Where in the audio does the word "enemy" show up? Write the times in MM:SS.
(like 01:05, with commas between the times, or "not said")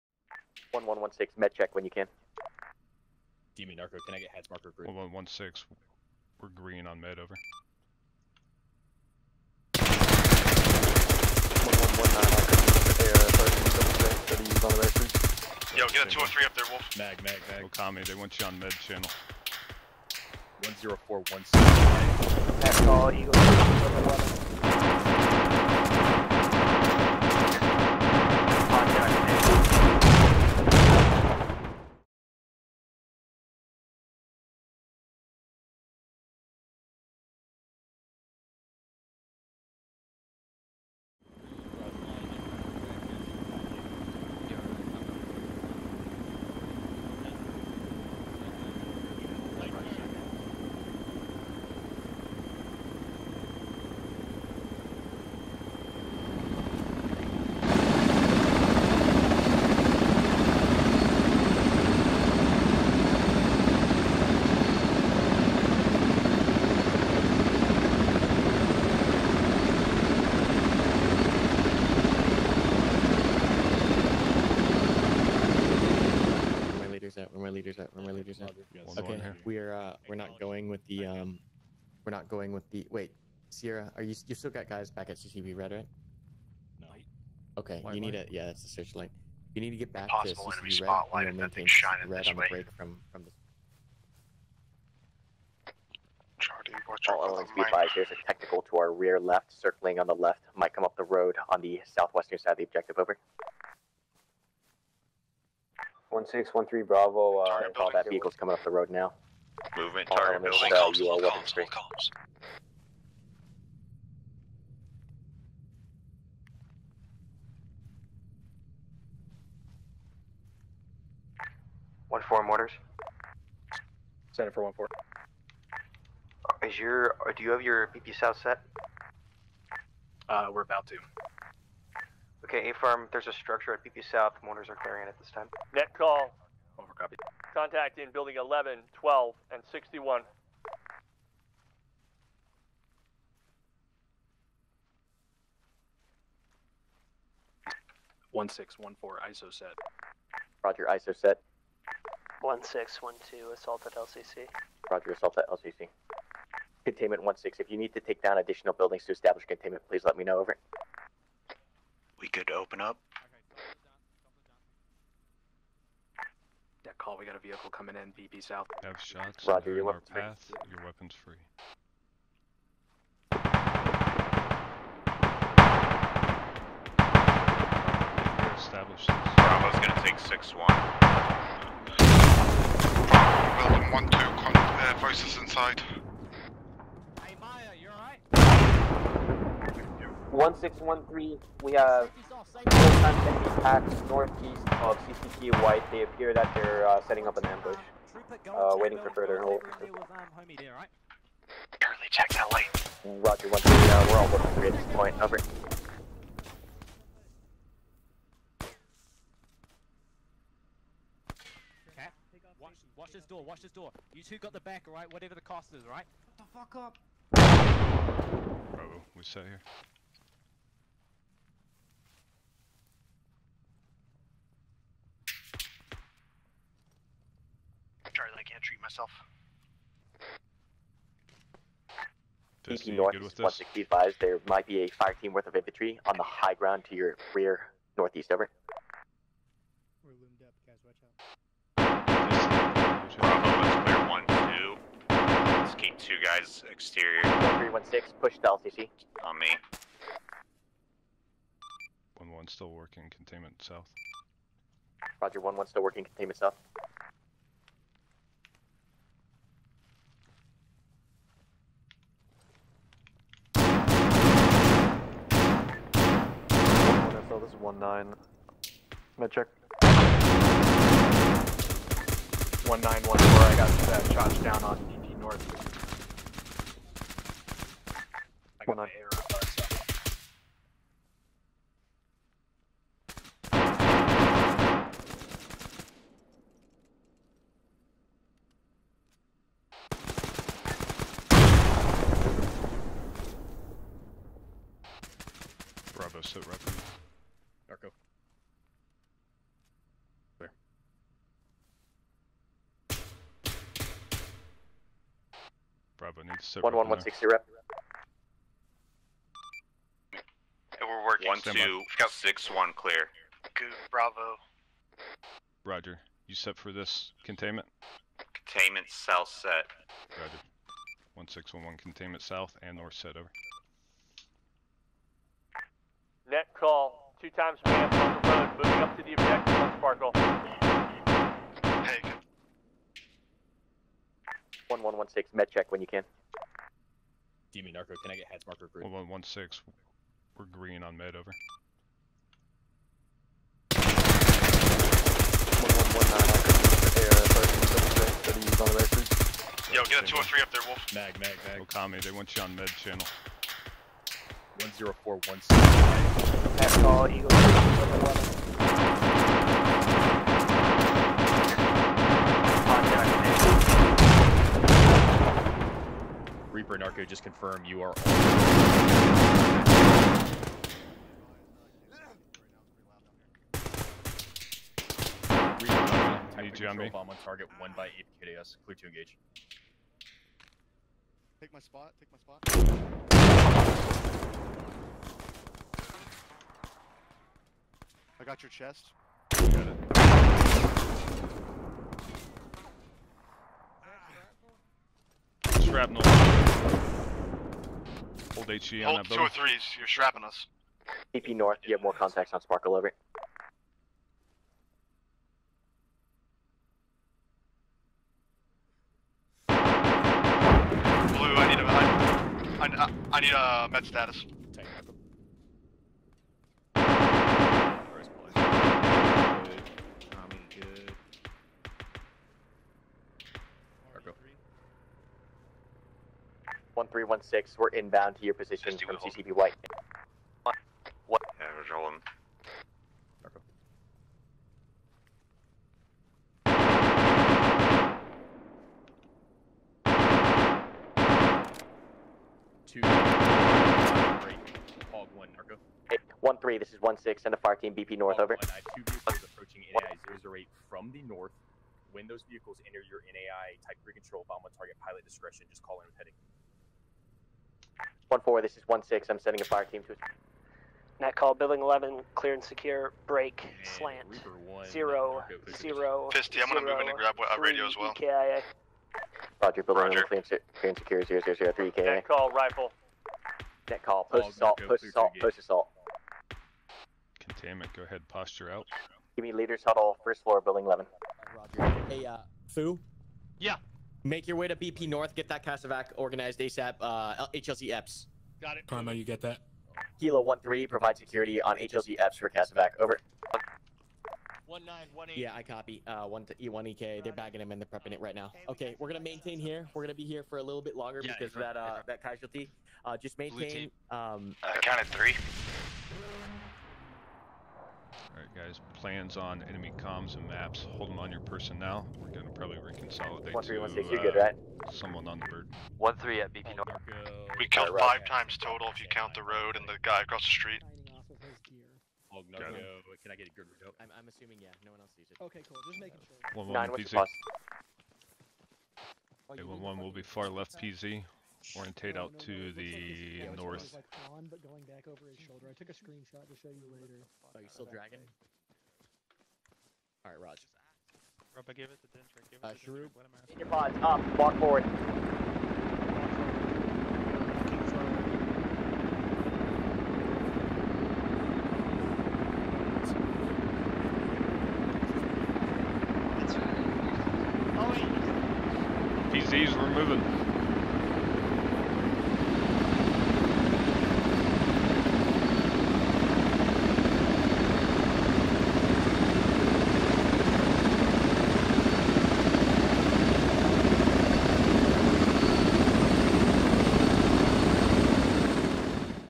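03:13, 08:29.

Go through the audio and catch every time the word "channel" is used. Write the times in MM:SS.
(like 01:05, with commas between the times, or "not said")
00:18, 05:52.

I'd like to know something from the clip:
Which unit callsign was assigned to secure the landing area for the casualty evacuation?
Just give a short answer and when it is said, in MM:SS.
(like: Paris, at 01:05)
Kilo 13, at 08:09.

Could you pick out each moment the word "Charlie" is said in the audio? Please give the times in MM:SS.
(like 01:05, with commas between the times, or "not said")
01:36.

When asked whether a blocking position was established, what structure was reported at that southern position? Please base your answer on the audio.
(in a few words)
A farm.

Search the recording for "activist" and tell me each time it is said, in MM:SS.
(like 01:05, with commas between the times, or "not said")
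not said.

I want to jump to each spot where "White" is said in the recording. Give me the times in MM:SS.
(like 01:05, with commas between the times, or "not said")
03:15, 07:09.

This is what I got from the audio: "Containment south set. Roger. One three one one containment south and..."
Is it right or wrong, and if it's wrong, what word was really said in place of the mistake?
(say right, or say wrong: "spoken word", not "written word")
wrong: "six", not "three".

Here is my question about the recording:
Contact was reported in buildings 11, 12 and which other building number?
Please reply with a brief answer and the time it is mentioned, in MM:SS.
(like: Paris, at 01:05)
61, at 02:19.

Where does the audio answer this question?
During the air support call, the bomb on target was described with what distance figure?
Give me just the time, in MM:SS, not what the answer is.
06:17.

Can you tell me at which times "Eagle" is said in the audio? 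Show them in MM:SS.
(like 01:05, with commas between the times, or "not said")
00:23, 05:57.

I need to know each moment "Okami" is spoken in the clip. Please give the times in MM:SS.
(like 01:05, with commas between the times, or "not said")
00:17, 05:51.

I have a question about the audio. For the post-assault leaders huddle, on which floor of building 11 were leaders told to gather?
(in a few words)
first floor.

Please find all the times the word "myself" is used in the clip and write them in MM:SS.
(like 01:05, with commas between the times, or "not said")
03:48.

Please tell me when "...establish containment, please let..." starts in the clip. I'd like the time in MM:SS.
02:39.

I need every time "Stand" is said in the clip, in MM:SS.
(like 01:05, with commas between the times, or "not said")
05:11.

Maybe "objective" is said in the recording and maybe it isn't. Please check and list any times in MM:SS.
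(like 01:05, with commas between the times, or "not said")
01:42, 05:29.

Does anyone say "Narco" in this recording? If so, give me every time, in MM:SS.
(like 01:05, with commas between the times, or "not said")
00:03, 05:37, 06:06.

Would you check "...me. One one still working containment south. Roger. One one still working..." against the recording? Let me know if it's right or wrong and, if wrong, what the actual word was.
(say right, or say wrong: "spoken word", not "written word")
right.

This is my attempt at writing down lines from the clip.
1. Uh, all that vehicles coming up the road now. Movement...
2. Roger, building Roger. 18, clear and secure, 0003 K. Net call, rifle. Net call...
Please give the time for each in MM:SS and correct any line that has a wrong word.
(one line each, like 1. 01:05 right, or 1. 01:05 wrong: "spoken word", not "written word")
1. 01:47 right
2. 07:49 wrong: "11", not "18".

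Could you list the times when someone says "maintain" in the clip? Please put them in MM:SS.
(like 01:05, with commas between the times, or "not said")
01:31, 08:18, 08:23.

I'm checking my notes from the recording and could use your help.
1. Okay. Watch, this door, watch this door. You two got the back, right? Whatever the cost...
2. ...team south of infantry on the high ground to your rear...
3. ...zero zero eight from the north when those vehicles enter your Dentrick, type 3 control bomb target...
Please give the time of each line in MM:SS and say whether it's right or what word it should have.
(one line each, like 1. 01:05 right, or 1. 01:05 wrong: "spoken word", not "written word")
1. 03:31 right
2. 03:55 wrong: "worth", not "south"
3. 07:30 wrong: "NAI", not "Dentrick".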